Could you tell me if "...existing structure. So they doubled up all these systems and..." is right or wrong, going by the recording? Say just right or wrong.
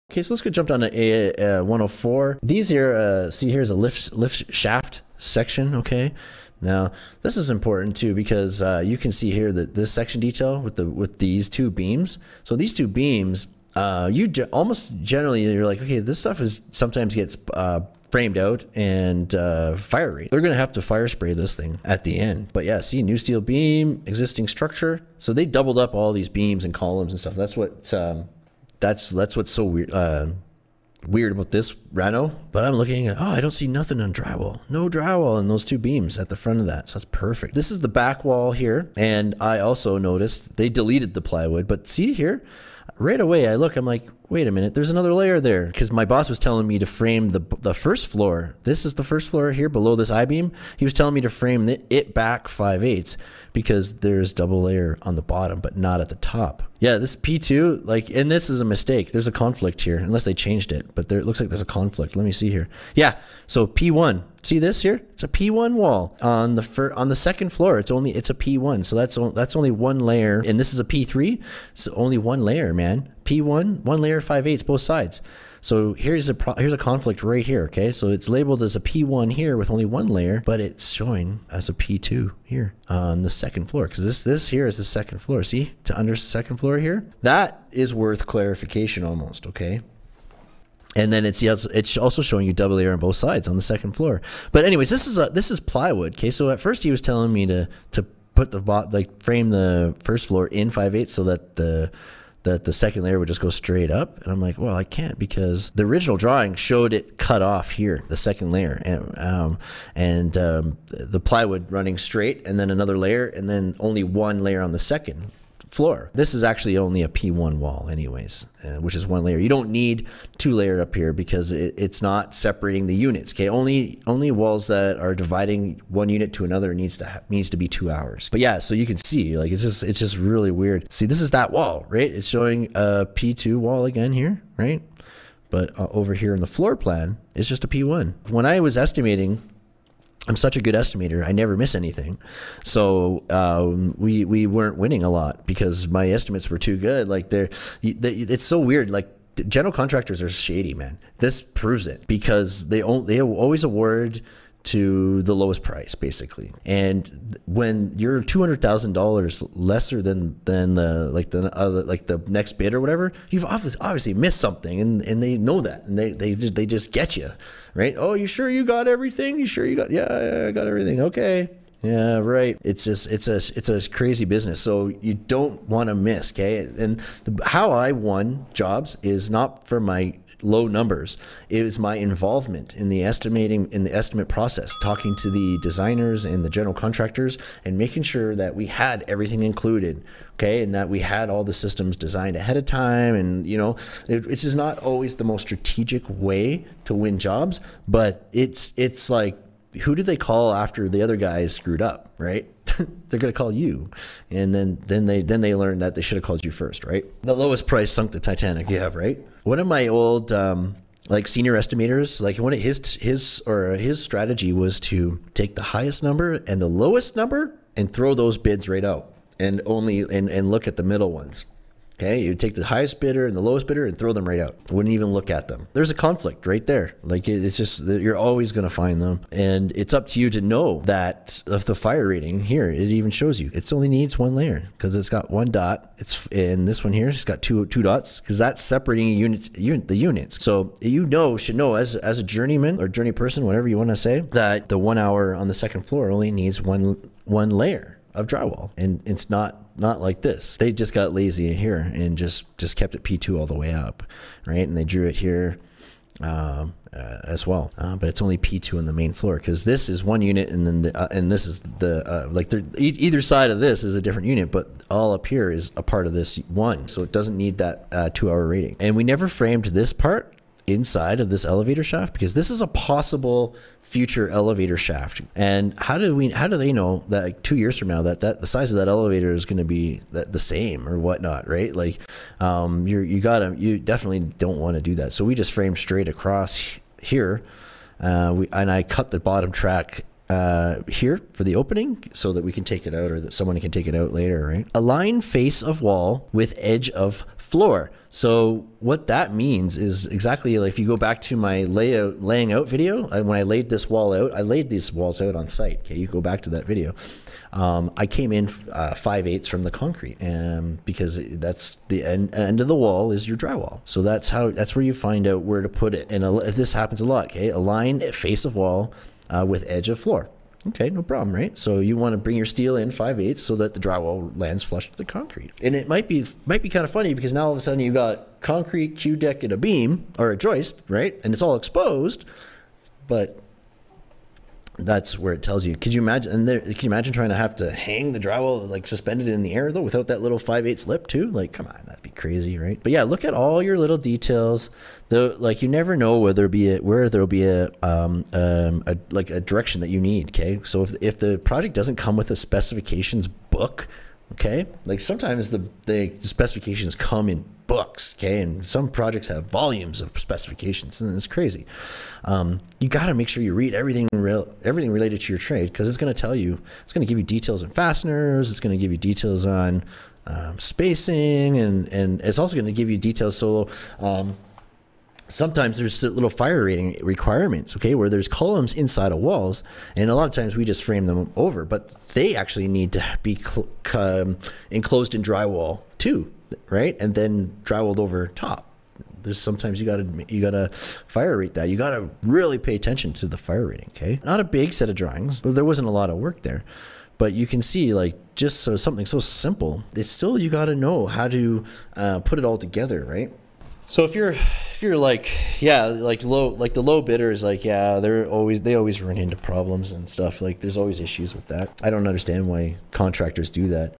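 wrong.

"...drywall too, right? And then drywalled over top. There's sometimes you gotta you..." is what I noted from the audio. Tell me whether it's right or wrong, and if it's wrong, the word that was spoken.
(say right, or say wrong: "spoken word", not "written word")
right.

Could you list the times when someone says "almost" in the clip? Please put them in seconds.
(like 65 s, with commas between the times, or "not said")
14 s, 89 s.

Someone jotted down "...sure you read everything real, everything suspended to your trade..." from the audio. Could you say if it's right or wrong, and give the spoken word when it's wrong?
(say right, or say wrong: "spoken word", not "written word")
wrong: "related", not "suspended".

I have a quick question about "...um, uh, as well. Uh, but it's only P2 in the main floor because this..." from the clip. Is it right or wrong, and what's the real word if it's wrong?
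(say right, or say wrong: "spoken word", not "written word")
right.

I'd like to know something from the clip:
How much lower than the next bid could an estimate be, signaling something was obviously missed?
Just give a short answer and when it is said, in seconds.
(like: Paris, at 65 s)
$200,000, at 158 s.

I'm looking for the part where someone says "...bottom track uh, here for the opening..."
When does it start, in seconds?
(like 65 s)
289 s.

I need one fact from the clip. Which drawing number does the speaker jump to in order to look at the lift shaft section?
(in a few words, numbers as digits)
104.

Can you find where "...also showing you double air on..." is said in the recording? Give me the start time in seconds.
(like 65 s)
91 s.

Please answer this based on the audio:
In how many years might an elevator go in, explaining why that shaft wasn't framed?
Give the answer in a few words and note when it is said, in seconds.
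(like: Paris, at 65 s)
2, at 277 s.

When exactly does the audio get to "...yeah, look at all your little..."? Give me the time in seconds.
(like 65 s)
342 s.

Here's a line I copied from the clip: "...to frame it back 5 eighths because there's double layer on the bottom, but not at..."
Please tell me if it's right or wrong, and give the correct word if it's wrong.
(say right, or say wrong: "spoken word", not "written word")
right.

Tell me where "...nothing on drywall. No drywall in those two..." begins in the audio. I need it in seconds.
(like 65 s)
33 s.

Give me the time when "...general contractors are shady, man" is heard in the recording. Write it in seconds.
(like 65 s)
149 s.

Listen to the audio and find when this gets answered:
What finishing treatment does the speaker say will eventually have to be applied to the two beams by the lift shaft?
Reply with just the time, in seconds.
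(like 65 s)
20 s.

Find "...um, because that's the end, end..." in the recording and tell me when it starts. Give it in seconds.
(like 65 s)
310 s.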